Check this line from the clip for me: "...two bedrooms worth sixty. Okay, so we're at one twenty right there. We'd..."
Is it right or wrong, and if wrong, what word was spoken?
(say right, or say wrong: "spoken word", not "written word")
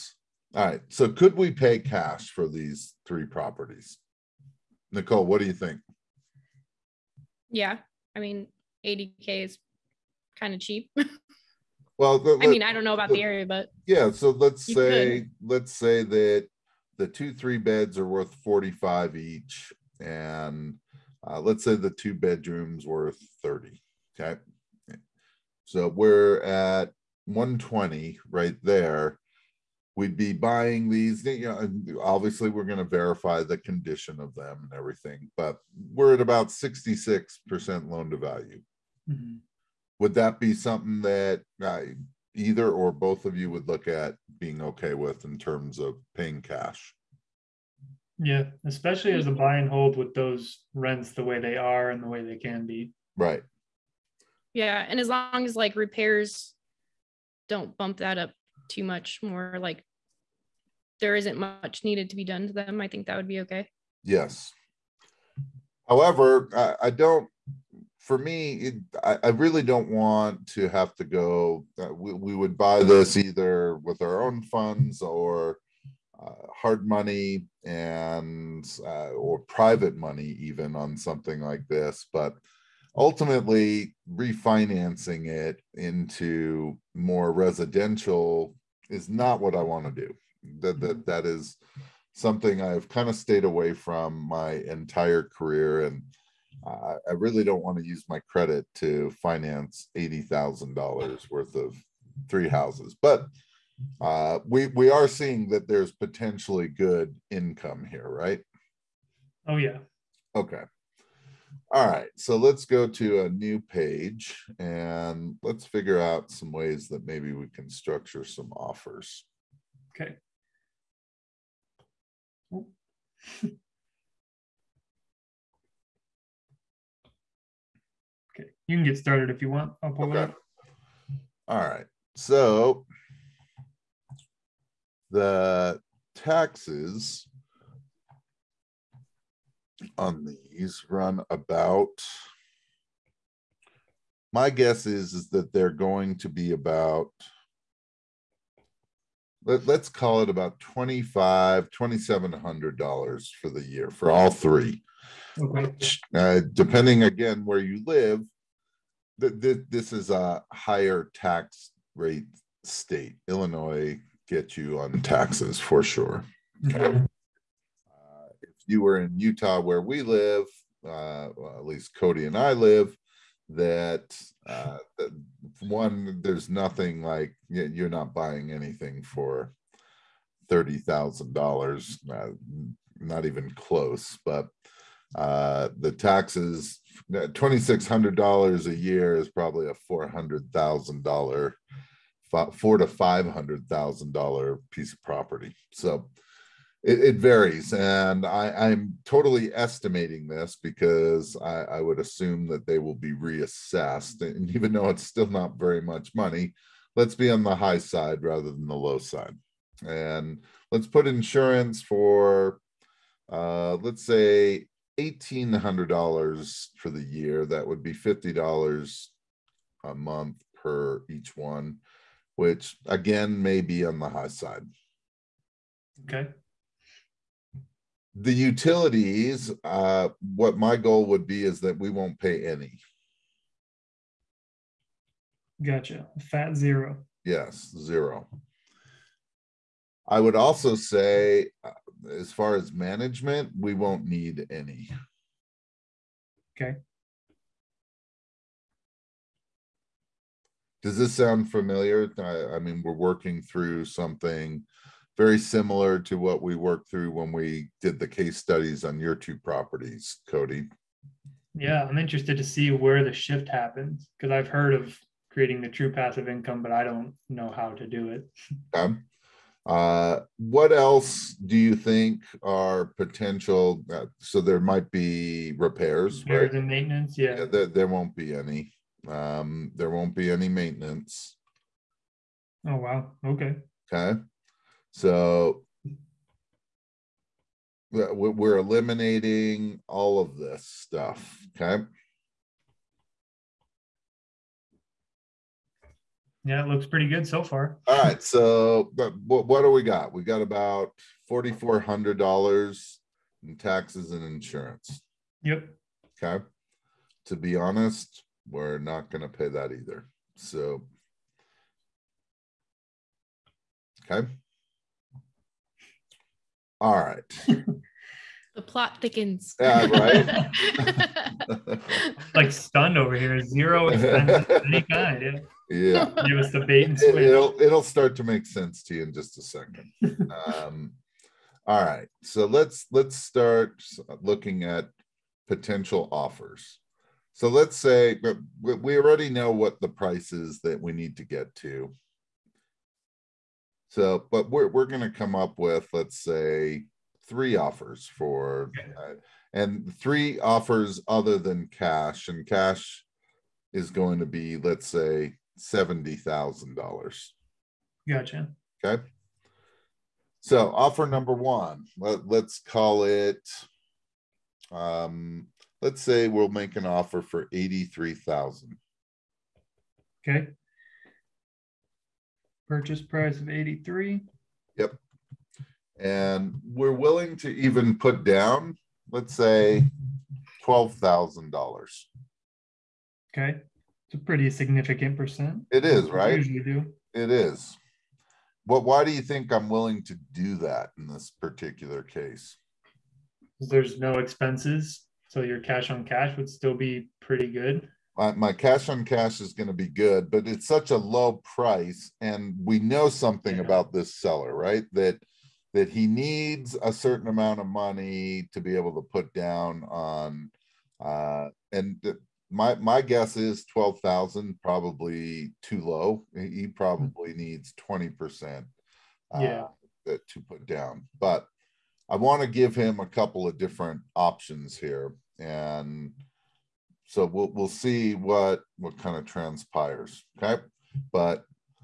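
wrong: "thirty", not "sixty".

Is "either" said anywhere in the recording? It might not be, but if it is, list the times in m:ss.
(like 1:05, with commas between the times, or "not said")
0:42, 1:13, 5:09.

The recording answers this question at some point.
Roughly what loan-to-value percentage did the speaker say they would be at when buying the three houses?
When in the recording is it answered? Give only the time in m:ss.
0:36.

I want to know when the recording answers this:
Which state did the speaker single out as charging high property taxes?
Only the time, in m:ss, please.
2:43.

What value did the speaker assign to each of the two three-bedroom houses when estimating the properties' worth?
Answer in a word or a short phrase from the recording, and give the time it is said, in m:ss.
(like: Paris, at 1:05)
45,000, at 0:18.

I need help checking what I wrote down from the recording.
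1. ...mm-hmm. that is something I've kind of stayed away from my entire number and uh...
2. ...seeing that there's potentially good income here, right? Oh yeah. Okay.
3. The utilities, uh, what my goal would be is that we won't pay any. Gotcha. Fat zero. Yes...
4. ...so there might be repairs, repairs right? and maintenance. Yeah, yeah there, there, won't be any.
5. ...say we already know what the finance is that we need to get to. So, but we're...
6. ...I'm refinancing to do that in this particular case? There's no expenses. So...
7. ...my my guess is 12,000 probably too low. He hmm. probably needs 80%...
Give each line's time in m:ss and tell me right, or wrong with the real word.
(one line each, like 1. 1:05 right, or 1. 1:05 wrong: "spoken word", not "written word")
1. 1:30 wrong: "career", not "number"
2. 1:45 right
3. 3:48 right
4. 4:34 right
5. 5:37 wrong: "price", not "finance"
6. 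6:29 wrong: "willing", not "refinancing"
7. 6:52 wrong: "20", not "80".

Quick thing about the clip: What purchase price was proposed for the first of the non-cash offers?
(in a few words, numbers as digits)
83,000.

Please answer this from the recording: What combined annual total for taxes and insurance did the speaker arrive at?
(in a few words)
4,400.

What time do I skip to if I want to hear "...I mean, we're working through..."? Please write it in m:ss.
4:12.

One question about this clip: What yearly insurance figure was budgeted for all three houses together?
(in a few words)
$1,800.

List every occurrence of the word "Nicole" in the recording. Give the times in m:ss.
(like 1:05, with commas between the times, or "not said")
0:04.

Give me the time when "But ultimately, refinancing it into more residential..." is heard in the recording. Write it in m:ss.
1:22.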